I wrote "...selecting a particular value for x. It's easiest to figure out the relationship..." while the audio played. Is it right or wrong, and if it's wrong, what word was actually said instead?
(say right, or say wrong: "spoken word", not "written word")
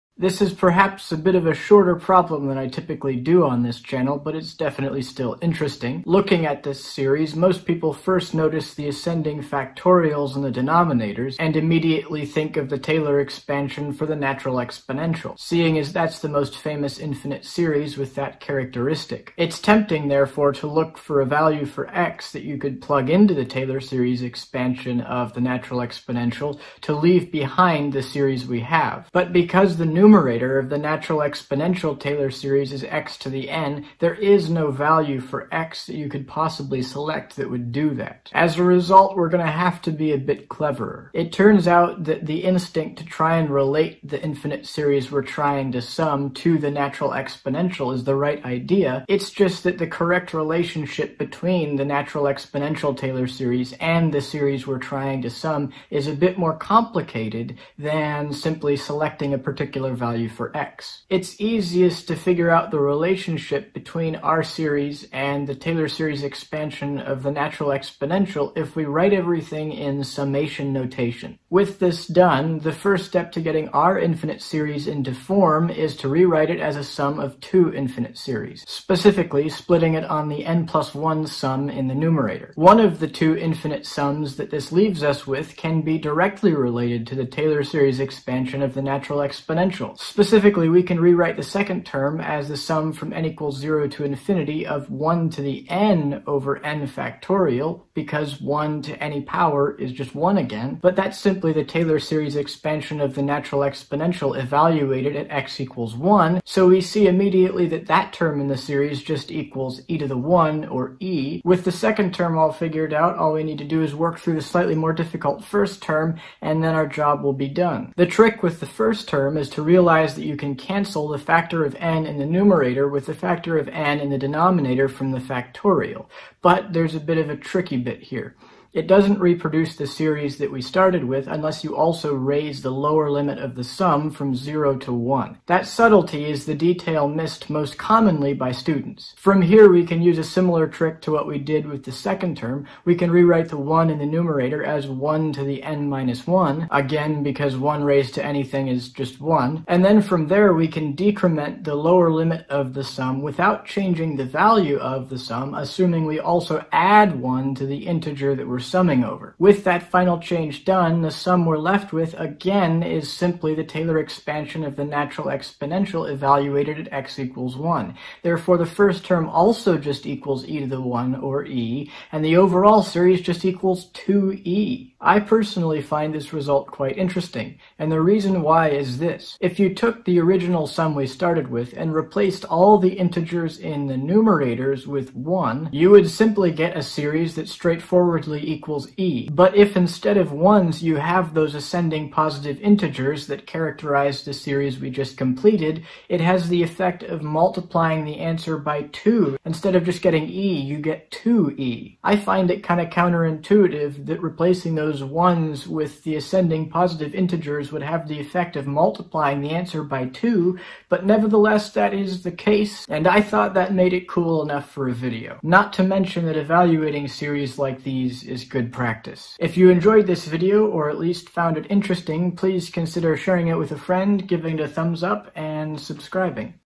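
right.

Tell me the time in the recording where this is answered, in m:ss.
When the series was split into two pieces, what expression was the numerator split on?
1:20.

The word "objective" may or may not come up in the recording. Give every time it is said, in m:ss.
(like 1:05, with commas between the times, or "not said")
not said.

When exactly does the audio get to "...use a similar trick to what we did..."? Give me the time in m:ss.
2:20.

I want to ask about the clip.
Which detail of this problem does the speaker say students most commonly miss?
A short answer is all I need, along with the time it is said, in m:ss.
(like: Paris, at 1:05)
That subtlety, at 2:15.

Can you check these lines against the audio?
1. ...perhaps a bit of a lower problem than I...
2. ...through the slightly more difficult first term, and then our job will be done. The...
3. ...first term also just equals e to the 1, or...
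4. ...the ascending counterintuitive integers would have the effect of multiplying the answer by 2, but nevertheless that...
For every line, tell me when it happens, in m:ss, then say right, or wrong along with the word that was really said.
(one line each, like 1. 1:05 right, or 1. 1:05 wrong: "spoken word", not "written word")
1. 0:00 wrong: "shorter", not "lower"
2. 1:54 right
3. 2:48 right
4. 3:26 wrong: "positive", not "counterintuitive".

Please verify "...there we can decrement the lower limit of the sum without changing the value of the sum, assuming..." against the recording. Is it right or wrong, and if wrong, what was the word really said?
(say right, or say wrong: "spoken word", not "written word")
right.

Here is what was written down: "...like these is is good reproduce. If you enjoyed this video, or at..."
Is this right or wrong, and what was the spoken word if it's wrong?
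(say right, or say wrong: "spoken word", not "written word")
wrong: "practice", not "reproduce".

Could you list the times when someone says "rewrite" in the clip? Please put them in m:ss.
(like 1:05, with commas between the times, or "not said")
1:16, 1:30, 2:23.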